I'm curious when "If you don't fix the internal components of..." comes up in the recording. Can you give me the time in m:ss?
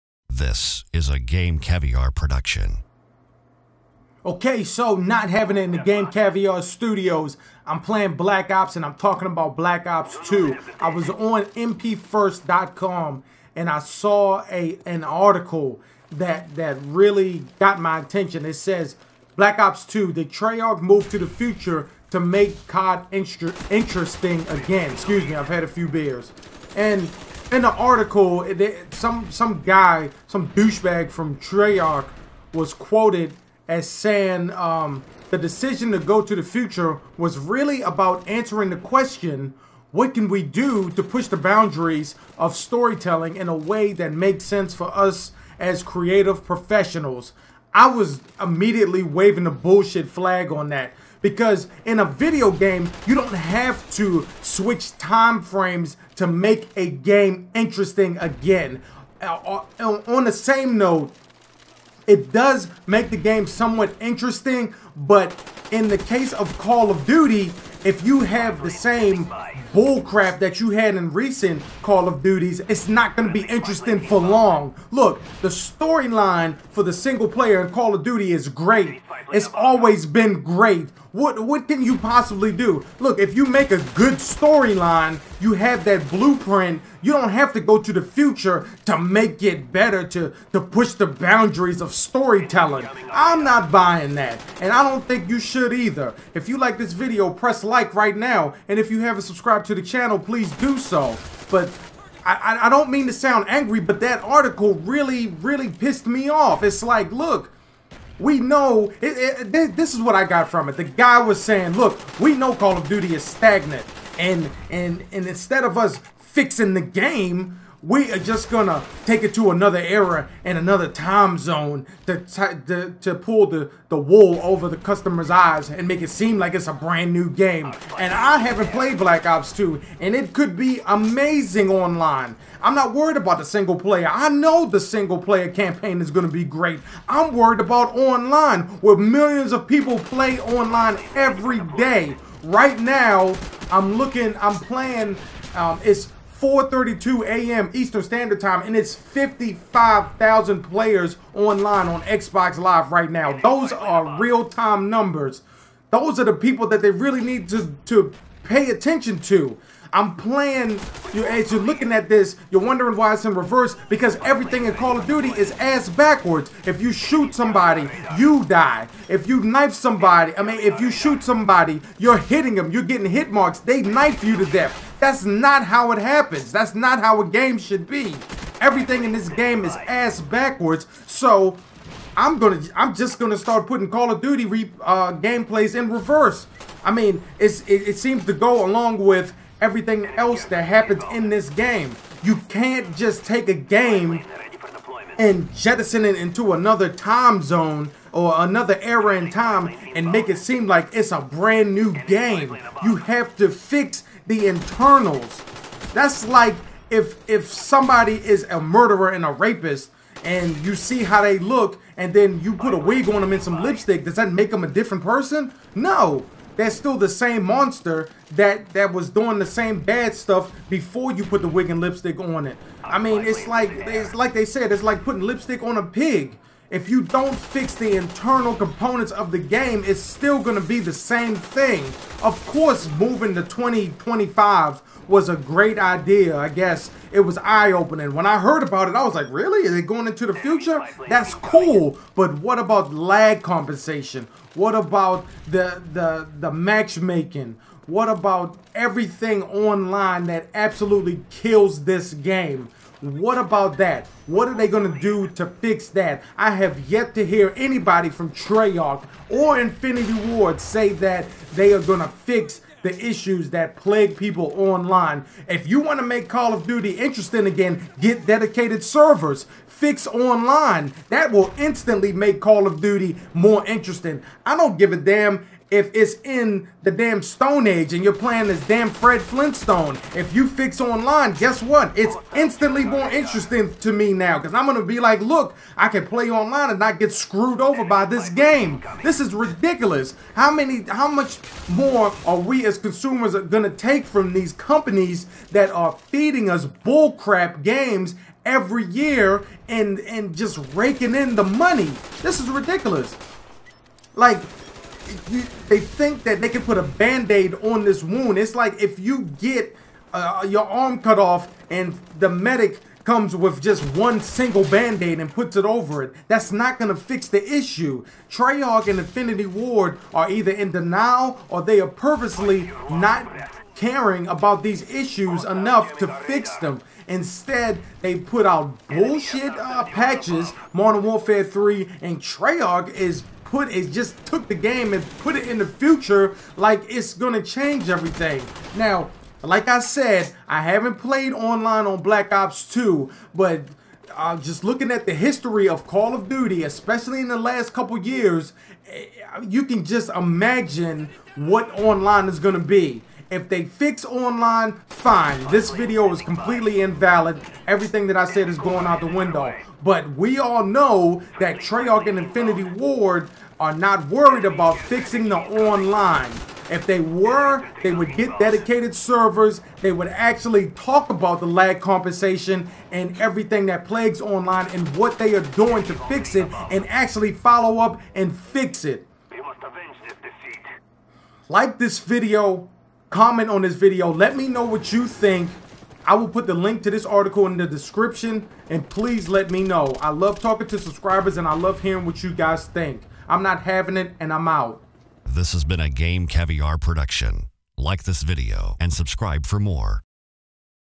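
3:46.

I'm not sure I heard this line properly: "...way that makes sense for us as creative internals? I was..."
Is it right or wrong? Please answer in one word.
wrong.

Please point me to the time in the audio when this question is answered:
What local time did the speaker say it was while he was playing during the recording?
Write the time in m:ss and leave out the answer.
2:26.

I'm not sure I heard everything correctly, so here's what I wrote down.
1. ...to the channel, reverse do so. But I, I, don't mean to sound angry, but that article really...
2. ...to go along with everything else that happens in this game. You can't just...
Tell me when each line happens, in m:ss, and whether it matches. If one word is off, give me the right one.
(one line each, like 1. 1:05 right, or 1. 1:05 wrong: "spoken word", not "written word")
1. 1:39 wrong: "please", not "reverse"
2. 3:08 right.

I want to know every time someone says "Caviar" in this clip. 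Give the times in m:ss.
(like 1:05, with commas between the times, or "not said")
0:01, 0:06, 6:36.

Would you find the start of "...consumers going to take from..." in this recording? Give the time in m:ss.
4:52.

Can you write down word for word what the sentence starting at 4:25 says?
If you want to make Call of Duty interesting again, get dedicated servers.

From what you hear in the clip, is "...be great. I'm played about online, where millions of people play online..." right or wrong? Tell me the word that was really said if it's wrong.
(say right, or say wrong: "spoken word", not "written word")
wrong: "worried", not "played".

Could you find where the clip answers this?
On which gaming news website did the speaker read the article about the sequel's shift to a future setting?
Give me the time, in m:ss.
0:11.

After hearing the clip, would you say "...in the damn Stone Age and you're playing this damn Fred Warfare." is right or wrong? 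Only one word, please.
wrong.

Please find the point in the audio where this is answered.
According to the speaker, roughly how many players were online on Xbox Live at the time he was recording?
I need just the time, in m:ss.
2:28.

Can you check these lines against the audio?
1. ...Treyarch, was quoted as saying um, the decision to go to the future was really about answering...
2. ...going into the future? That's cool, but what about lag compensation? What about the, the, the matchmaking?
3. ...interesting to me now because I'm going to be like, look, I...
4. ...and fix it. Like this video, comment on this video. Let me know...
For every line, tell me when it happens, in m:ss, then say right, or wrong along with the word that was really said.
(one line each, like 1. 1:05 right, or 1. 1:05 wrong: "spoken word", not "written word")
1. 0:31 right
2. 3:59 right
3. 4:43 right
4. 6:18 right.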